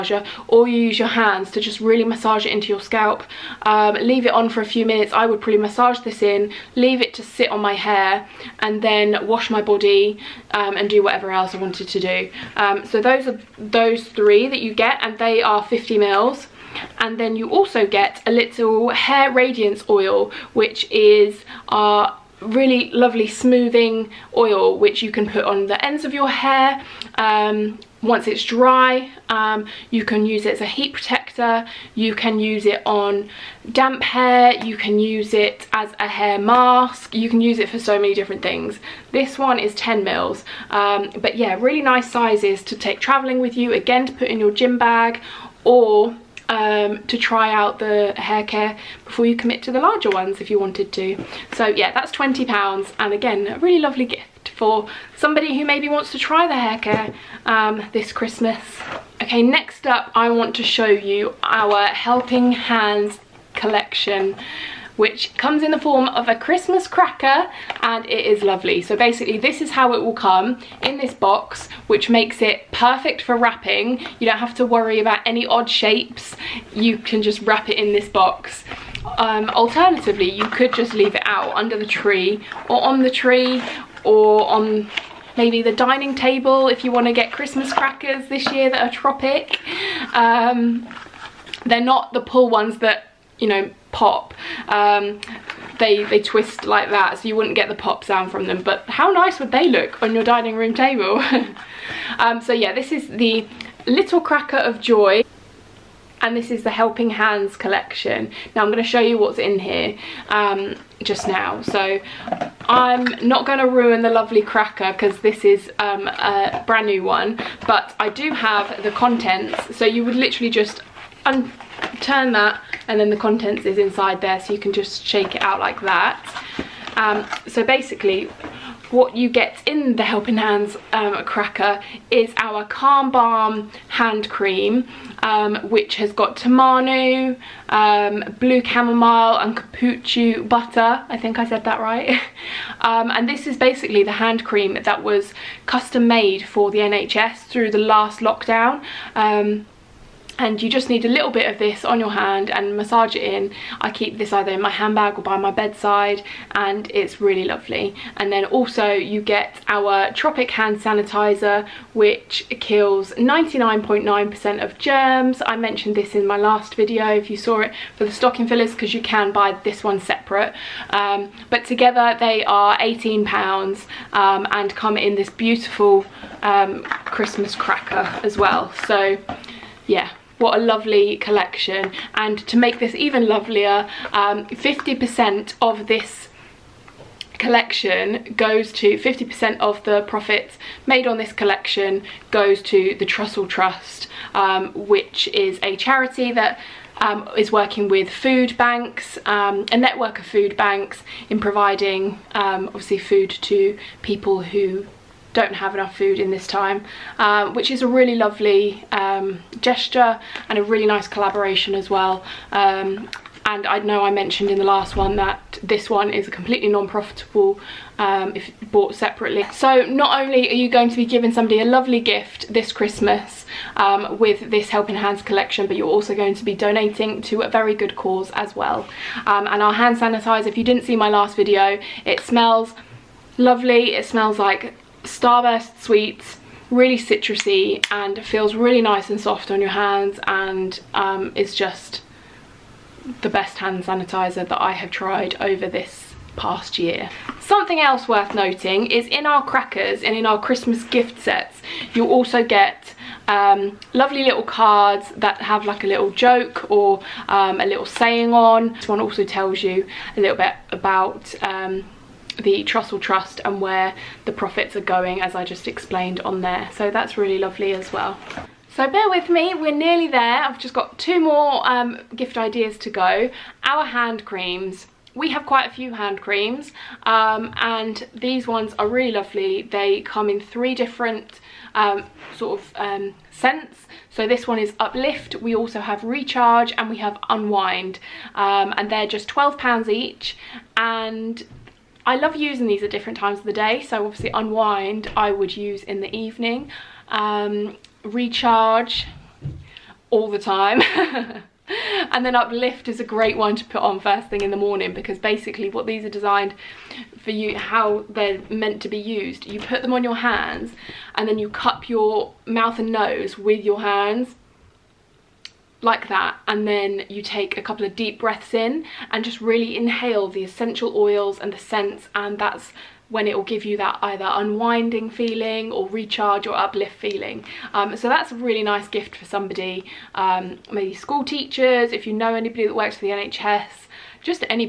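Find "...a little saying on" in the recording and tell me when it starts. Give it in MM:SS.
04:17.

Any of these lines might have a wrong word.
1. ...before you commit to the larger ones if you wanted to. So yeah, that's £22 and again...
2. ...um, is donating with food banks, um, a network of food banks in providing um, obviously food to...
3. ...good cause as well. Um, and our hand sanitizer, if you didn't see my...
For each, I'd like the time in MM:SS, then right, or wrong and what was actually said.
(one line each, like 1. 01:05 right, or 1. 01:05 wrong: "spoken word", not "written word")
1. 00:49 wrong: "20", not "22"
2. 03:17 wrong: "working", not "donating"
3. 03:47 right.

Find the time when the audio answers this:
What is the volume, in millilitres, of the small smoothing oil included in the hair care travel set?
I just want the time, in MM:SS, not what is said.
00:39.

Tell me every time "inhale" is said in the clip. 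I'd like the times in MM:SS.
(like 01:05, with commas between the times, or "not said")
05:19.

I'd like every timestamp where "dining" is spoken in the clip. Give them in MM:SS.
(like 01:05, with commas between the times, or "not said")
01:25, 01:40.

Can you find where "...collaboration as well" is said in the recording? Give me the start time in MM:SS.
03:31.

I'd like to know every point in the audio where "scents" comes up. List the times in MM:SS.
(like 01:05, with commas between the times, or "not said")
04:43, 05:21.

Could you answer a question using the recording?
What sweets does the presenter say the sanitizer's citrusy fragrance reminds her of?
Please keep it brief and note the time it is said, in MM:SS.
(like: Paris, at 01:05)
Starburst, at 03:55.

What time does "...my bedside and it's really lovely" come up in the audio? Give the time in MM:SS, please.
02:35.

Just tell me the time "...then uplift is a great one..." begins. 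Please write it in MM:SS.
05:02.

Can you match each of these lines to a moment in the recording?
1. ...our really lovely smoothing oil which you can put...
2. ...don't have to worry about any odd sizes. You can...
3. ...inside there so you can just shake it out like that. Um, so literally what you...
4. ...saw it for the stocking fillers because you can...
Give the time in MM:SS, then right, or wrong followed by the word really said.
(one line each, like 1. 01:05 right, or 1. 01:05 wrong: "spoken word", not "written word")
1. 00:21 right
2. 01:14 wrong: "shapes", not "sizes"
3. 02:03 wrong: "basically", not "literally"
4. 02:47 right.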